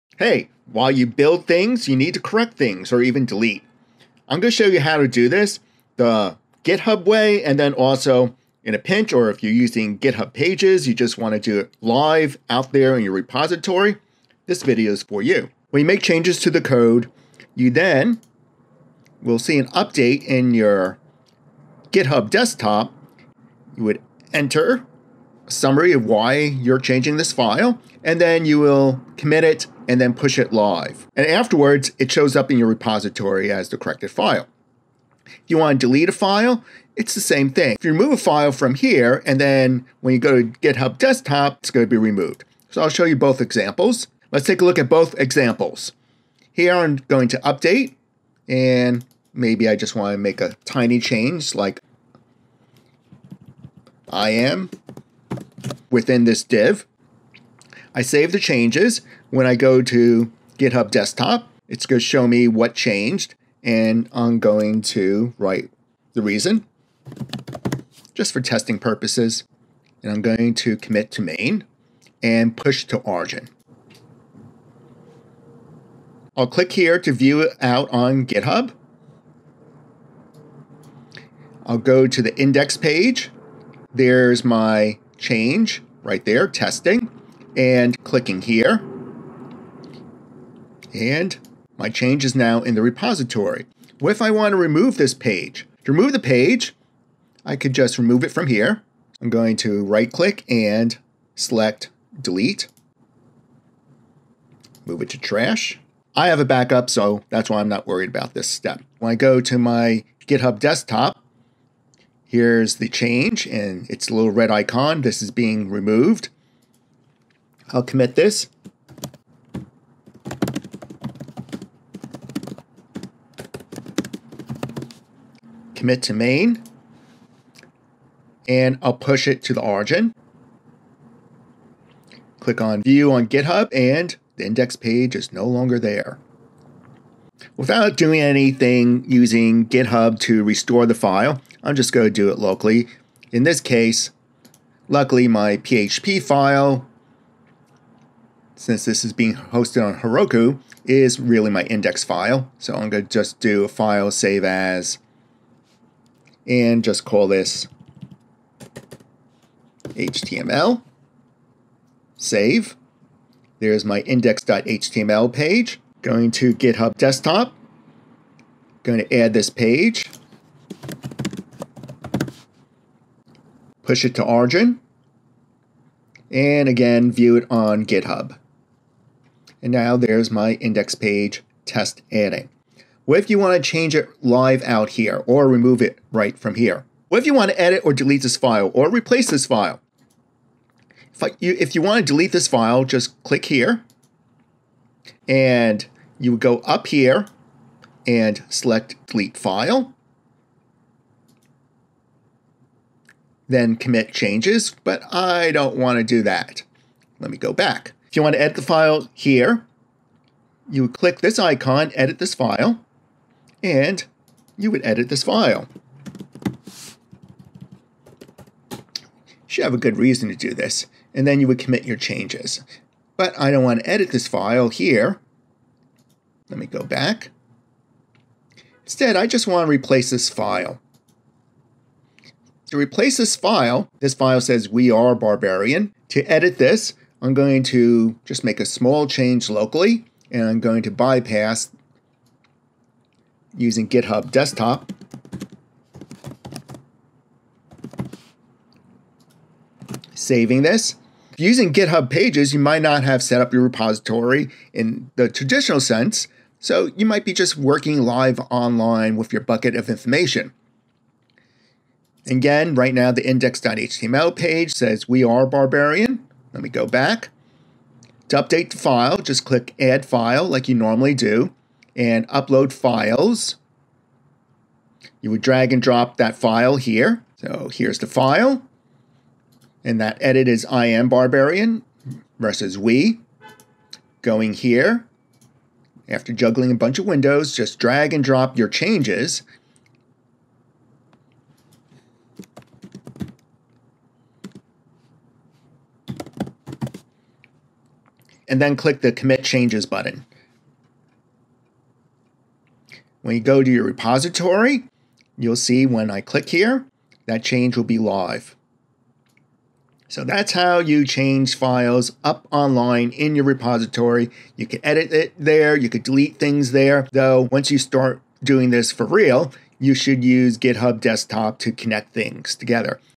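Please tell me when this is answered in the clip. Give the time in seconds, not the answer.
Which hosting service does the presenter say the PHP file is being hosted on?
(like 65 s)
150 s.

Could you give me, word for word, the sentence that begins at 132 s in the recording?
Click on view on GitHub and the index page is no longer there.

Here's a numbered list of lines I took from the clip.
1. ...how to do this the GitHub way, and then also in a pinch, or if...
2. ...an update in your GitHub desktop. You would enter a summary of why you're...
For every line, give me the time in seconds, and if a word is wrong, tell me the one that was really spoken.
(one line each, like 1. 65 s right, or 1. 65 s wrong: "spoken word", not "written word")
1. 4 s right
2. 19 s right.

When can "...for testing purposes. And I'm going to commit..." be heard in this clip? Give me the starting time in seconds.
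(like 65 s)
68 s.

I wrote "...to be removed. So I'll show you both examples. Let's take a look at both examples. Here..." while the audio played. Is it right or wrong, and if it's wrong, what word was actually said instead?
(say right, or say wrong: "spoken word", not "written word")
right.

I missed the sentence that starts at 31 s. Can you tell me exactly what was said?
And afterwards, it shows up in your repository as the corrected file.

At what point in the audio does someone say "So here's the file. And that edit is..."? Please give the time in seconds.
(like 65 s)
277 s.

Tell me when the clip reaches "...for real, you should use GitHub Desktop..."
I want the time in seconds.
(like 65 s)
318 s.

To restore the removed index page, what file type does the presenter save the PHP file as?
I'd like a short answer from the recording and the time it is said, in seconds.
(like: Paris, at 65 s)
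HTML, at 159 s.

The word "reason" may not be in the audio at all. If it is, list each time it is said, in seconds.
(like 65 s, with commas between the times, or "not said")
66 s, 219 s.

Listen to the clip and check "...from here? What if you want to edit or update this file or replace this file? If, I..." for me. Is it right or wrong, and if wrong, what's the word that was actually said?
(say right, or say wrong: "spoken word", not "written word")
wrong: "delete", not "update".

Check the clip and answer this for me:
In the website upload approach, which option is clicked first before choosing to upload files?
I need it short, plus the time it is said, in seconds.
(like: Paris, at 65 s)
Add file, at 269 s.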